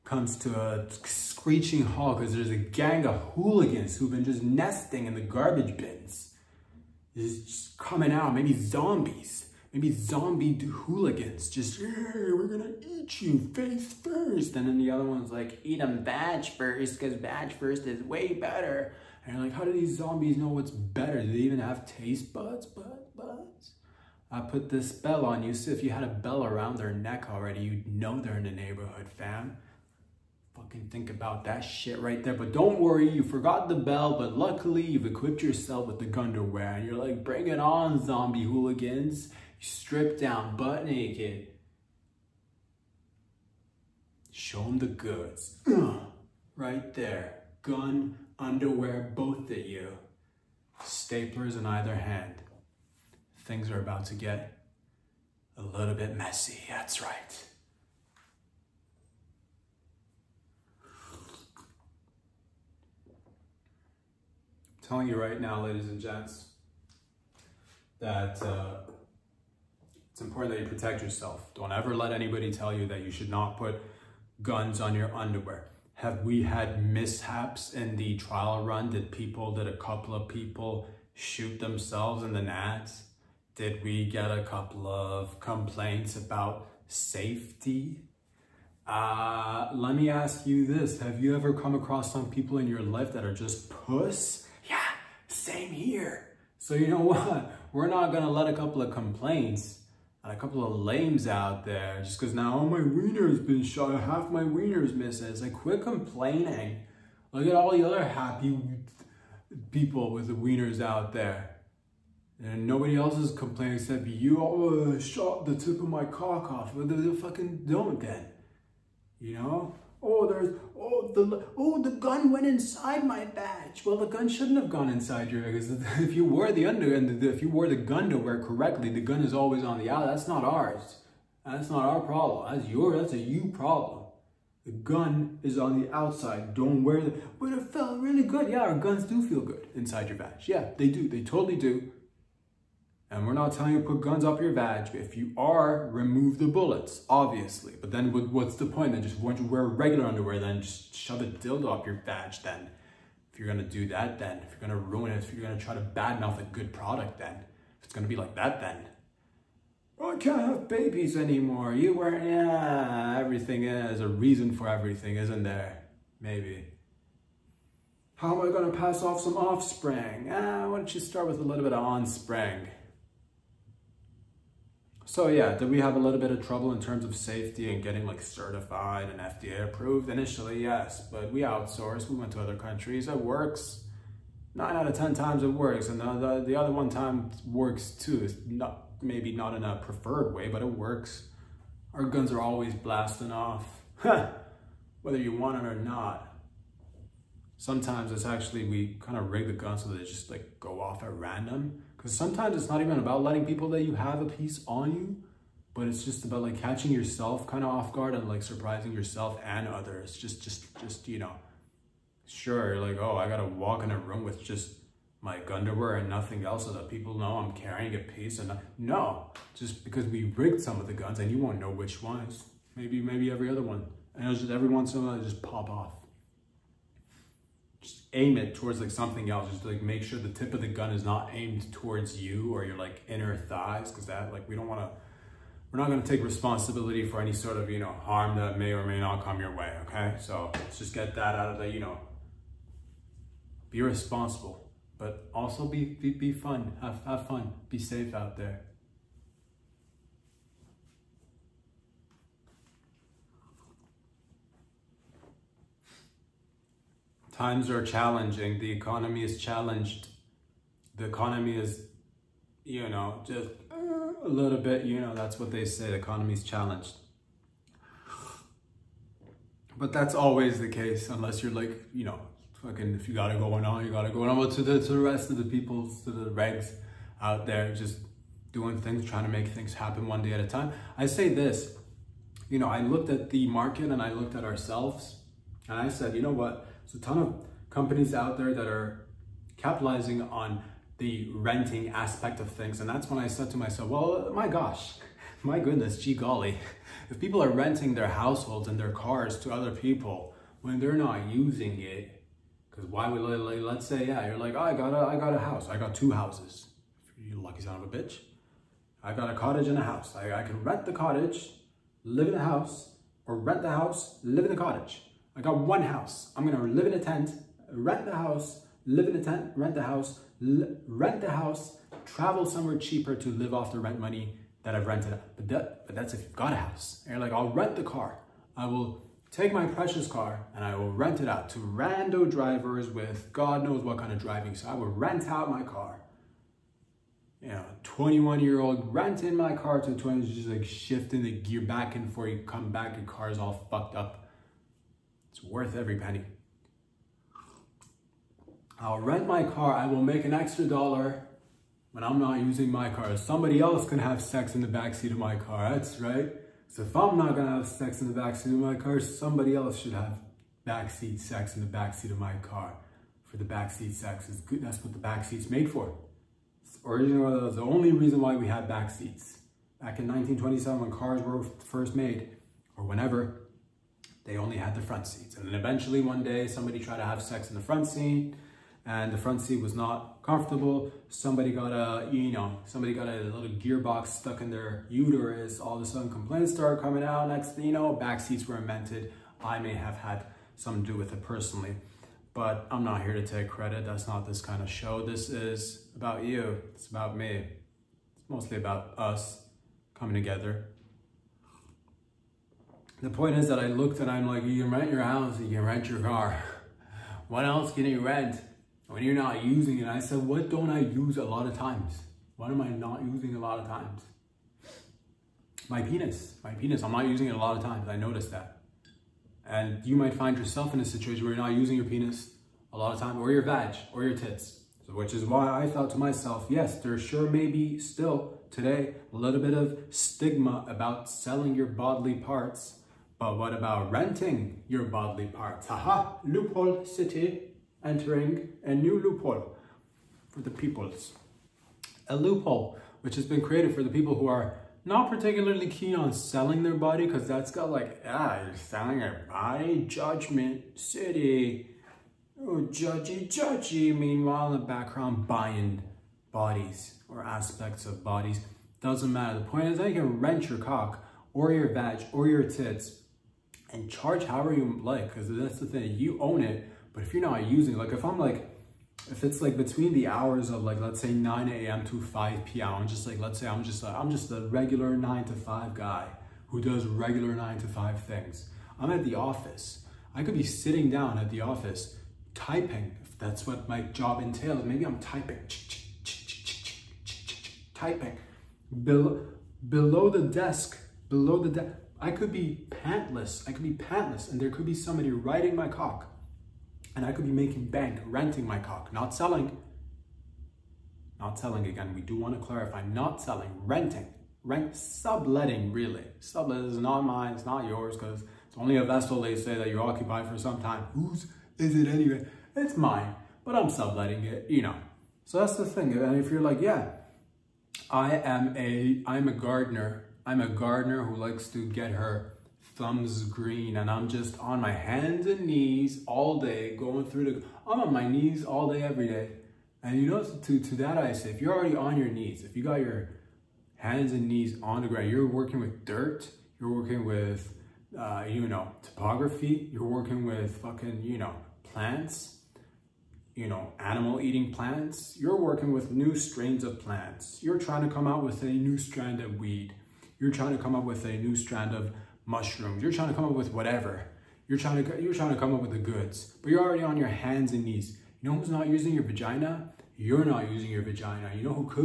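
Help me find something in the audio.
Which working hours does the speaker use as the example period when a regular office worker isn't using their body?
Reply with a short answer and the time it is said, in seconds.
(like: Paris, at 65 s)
9 a.m. to 5 p.m., at 471 s.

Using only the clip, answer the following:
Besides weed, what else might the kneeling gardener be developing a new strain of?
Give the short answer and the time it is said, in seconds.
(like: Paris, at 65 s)
Mushrooms, at 552 s.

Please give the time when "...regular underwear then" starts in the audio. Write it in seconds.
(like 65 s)
149 s.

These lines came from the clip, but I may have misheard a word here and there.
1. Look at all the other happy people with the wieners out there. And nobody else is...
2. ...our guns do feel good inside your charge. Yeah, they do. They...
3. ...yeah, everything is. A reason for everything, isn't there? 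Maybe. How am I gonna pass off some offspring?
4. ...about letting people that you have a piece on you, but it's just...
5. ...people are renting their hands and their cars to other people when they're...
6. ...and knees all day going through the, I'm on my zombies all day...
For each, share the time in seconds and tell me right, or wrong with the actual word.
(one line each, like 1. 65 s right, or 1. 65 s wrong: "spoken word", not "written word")
1. 107 s right
2. 138 s wrong: "badge", not "charge"
3. 162 s right
4. 202 s right
5. 297 s wrong: "households", not "hands"
6. 525 s wrong: "knees", not "zombies".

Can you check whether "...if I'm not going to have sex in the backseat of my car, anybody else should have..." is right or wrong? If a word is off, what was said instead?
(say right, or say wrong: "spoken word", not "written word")
wrong: "somebody", not "anybody".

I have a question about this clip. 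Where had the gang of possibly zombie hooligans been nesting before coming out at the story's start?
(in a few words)
Garbage bins.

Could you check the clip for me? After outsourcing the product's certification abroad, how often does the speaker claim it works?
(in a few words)
9 out of 10 times.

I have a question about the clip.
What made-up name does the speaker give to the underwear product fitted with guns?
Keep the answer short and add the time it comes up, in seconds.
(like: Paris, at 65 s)
Gunderwear, at 36 s.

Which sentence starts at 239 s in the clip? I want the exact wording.
Okay, so let's just get that out of the you know.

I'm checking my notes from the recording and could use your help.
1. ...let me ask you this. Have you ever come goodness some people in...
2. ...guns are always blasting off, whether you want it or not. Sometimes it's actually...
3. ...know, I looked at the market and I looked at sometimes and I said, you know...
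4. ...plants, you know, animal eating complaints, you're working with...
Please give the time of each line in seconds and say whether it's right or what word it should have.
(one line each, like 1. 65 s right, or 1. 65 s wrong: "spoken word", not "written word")
1. 89 s wrong: "across", not "goodness"
2. 192 s right
3. 282 s wrong: "ourselves", not "sometimes"
4. 541 s wrong: "plants", not "complaints".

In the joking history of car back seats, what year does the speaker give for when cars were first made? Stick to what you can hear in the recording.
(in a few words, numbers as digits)
1927.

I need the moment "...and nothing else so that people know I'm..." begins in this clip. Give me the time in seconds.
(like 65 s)
215 s.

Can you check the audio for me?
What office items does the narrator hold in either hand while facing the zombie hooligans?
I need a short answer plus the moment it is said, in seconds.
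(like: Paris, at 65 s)
Staplers, at 50 s.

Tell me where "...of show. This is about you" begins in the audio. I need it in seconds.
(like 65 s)
394 s.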